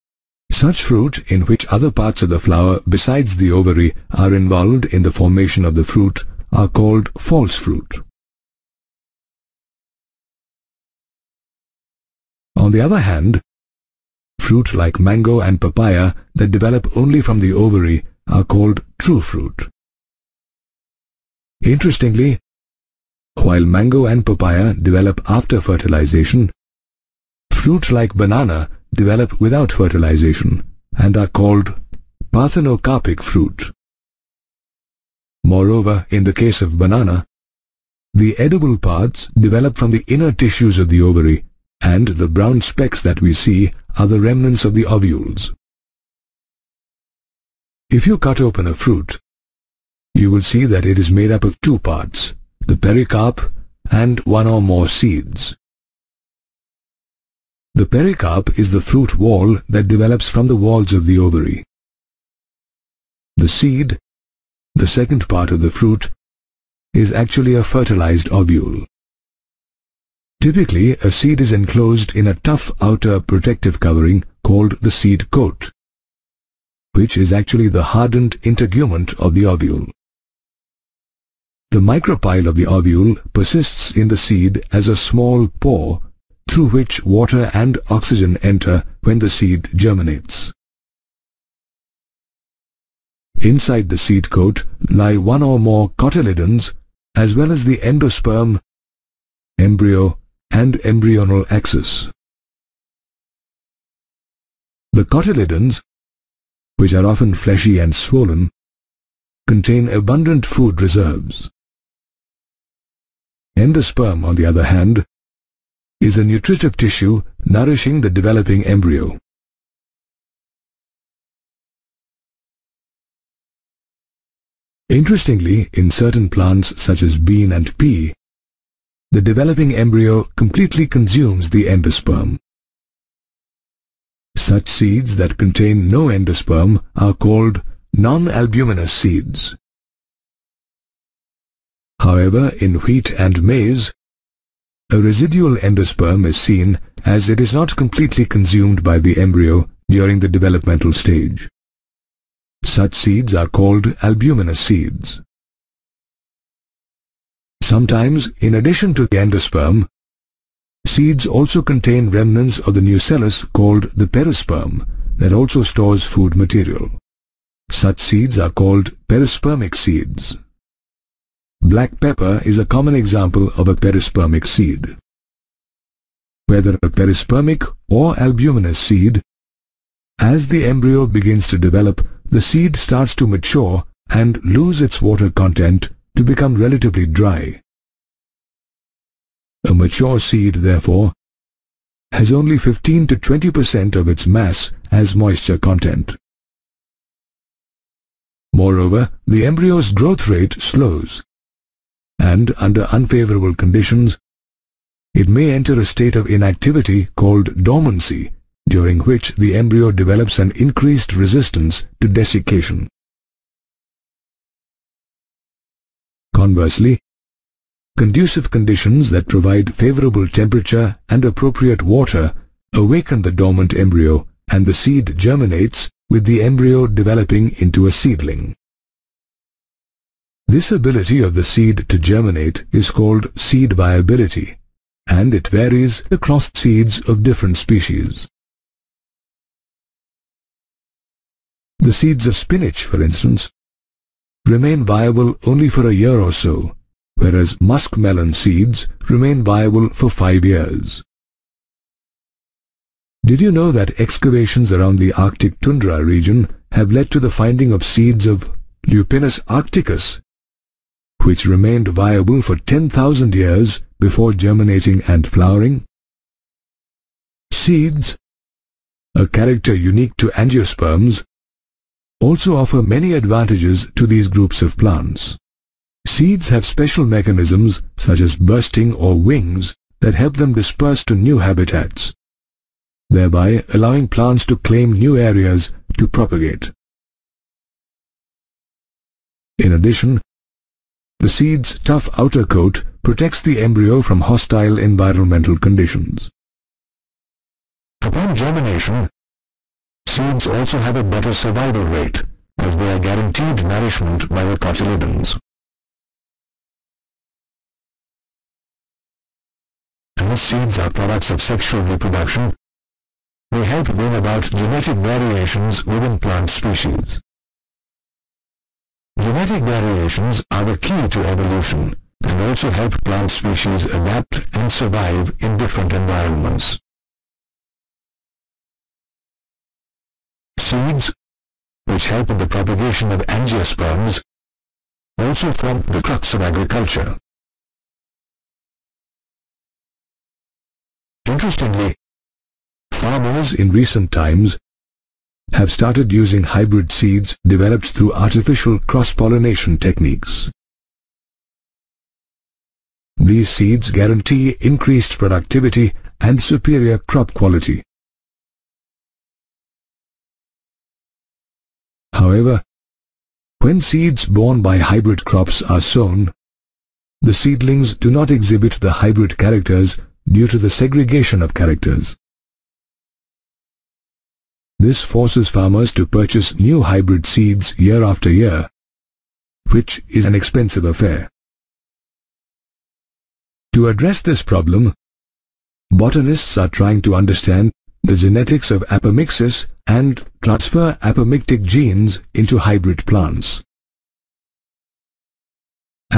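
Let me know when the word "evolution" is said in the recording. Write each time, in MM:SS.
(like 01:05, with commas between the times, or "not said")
05:21.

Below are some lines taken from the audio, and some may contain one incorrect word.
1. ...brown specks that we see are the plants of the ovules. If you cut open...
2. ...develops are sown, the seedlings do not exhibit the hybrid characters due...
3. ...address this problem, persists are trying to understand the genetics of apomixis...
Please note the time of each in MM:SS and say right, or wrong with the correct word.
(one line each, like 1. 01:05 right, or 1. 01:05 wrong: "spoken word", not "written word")
1. 00:42 wrong: "remnants", not "plants"
2. 06:05 wrong: "crops", not "develops"
3. 06:23 wrong: "botanists", not "persists".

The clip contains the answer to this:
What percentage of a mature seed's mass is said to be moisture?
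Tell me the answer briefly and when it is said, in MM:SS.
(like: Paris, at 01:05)
15 to 20 percent, at 03:12.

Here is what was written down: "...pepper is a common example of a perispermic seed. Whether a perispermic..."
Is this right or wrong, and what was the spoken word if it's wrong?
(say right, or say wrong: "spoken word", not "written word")
right.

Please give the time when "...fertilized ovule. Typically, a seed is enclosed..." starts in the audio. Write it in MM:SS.
01:07.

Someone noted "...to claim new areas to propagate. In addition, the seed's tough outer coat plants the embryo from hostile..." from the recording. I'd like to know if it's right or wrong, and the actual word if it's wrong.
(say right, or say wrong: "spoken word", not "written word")
wrong: "protects", not "plants".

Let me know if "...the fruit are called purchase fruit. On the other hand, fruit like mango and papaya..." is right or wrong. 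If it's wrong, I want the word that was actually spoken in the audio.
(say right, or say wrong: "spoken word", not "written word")
wrong: "false", not "purchase".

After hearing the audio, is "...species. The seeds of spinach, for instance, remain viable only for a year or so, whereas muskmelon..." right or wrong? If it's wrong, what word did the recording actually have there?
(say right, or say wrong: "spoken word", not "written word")
right.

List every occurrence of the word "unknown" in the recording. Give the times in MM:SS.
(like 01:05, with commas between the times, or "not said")
not said.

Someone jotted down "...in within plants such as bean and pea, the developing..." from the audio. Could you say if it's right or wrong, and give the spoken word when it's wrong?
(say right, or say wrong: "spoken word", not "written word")
wrong: "certain", not "within".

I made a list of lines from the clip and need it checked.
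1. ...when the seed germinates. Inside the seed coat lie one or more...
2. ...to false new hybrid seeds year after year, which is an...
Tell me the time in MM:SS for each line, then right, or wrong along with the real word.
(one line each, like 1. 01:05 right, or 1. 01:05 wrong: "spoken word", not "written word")
1. 01:29 right
2. 06:15 wrong: "purchase", not "false".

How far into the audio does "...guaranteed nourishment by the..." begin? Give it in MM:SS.
05:02.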